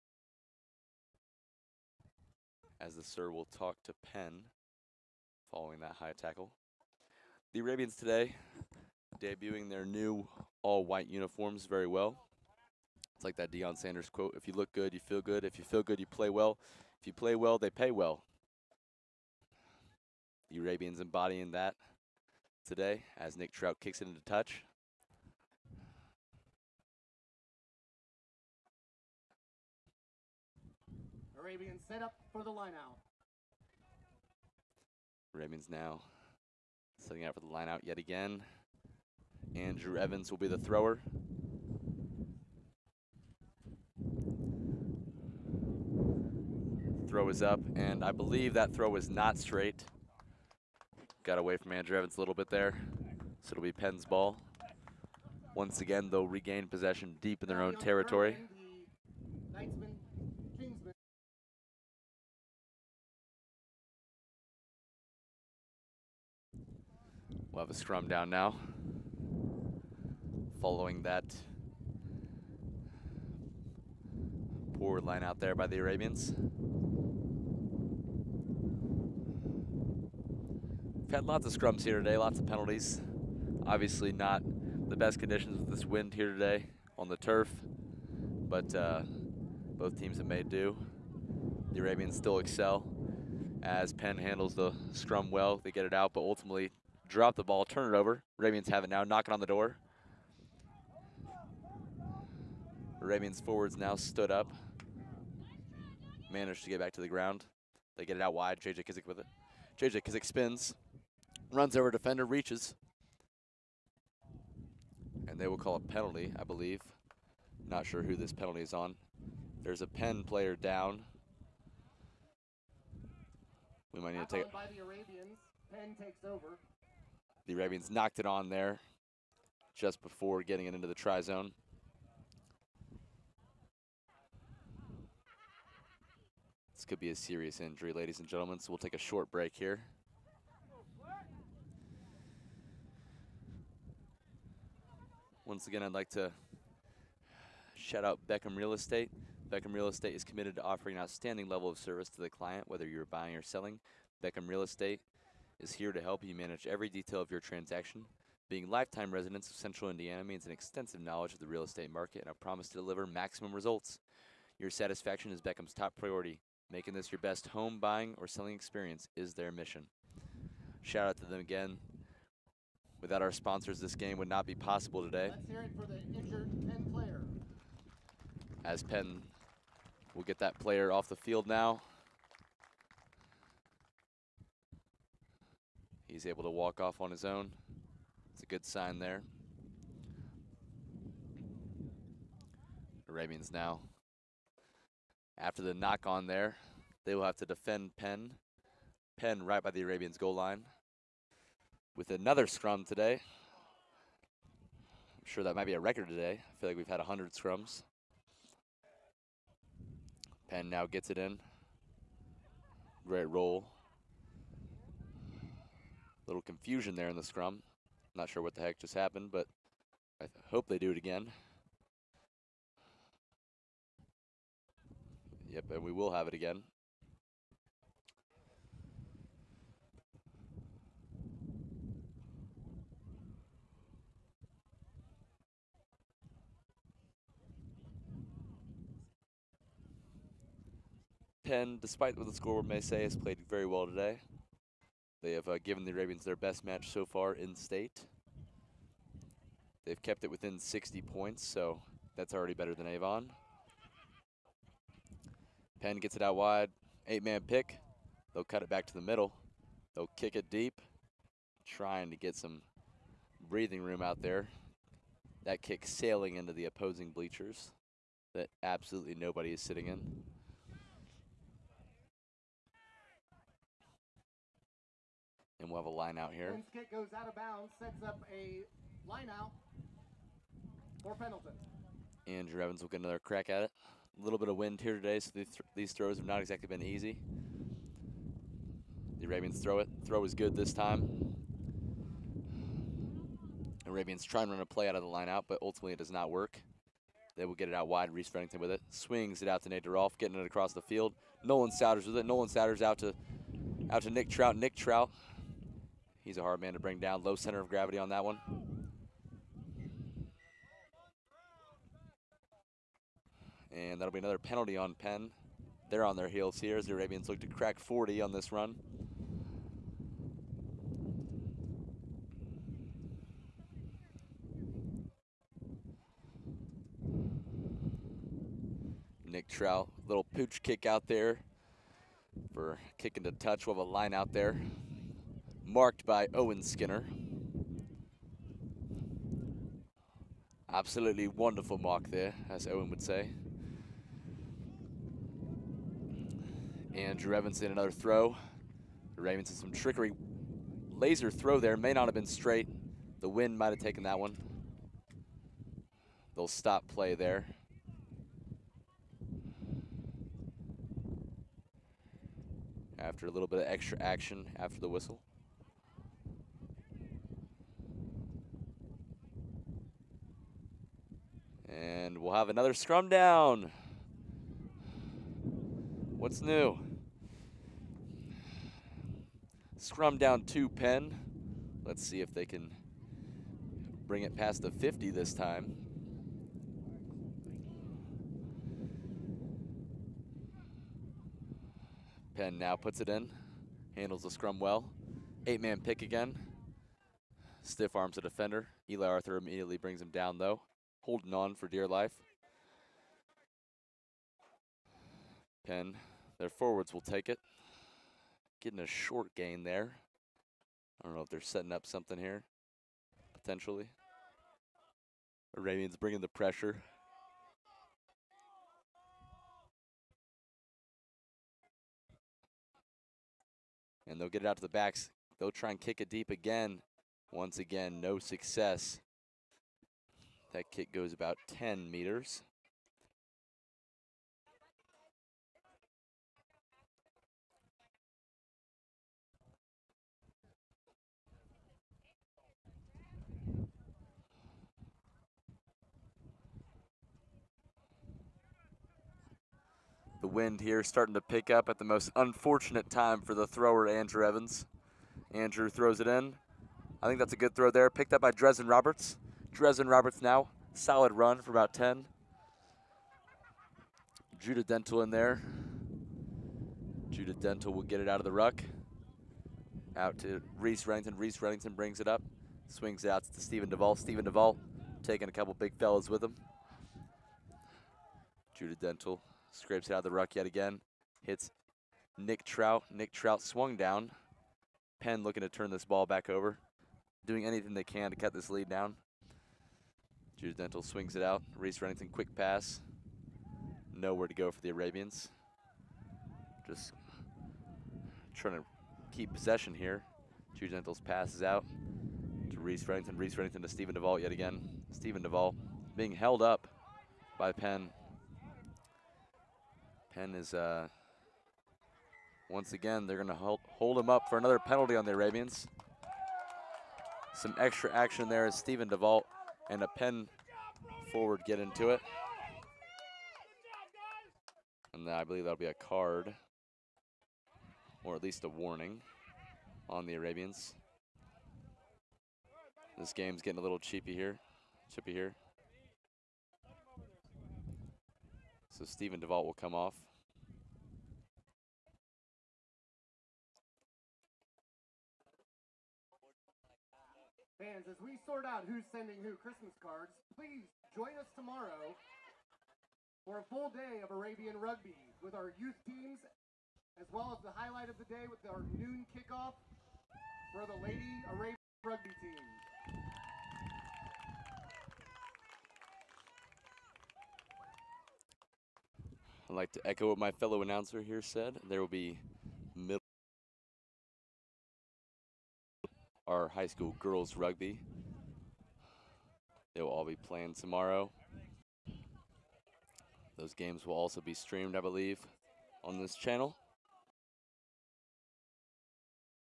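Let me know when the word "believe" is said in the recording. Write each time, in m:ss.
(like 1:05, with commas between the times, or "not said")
0:48, 1:56, 8:45, 9:44.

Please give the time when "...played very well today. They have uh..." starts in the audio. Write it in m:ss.
4:03.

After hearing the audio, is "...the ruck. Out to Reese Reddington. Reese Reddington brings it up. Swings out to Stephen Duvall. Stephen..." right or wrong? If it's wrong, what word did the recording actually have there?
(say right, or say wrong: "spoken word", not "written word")
right.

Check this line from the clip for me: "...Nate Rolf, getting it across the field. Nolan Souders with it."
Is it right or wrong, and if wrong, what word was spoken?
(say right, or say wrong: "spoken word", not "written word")
right.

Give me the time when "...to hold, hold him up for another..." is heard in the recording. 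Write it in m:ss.
8:33.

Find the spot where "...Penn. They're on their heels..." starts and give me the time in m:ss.
5:14.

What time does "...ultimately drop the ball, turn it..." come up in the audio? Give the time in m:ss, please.
1:36.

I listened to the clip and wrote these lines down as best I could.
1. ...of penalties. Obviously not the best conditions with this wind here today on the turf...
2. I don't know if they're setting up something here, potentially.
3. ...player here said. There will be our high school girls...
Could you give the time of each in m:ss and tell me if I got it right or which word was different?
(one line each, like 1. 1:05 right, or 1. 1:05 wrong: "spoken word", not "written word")
1. 1:22 right
2. 6:51 right
3. 9:30 wrong: "announcer", not "player".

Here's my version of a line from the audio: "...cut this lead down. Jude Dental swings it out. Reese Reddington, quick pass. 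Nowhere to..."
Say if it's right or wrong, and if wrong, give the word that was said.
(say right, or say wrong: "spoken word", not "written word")
right.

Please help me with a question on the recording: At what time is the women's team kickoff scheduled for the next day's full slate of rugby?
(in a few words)
noon.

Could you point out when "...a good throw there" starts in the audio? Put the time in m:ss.
7:37.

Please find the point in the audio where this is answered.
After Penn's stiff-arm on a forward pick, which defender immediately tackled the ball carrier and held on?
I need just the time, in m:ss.
6:38.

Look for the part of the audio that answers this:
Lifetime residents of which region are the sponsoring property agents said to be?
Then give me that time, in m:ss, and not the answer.
2:39.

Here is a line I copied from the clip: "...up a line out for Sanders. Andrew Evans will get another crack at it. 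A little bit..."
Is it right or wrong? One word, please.
wrong.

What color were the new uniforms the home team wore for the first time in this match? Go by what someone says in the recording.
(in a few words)
all-white.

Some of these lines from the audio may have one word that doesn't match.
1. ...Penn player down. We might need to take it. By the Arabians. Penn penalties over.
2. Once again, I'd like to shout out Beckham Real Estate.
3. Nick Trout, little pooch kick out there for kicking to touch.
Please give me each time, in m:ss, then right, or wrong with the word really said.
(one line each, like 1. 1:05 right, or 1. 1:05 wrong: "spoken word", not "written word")
1. 1:59 wrong: "takes", not "penalties"
2. 2:25 right
3. 5:29 right.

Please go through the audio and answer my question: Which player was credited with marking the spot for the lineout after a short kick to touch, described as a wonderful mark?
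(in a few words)
Owen Skinner.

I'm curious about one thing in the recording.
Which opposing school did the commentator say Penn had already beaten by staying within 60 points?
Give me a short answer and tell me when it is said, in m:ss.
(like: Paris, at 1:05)
Avon, at 4:12.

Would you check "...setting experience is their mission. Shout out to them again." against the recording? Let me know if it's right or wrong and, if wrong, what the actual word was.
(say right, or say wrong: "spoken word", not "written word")
wrong: "selling", not "setting".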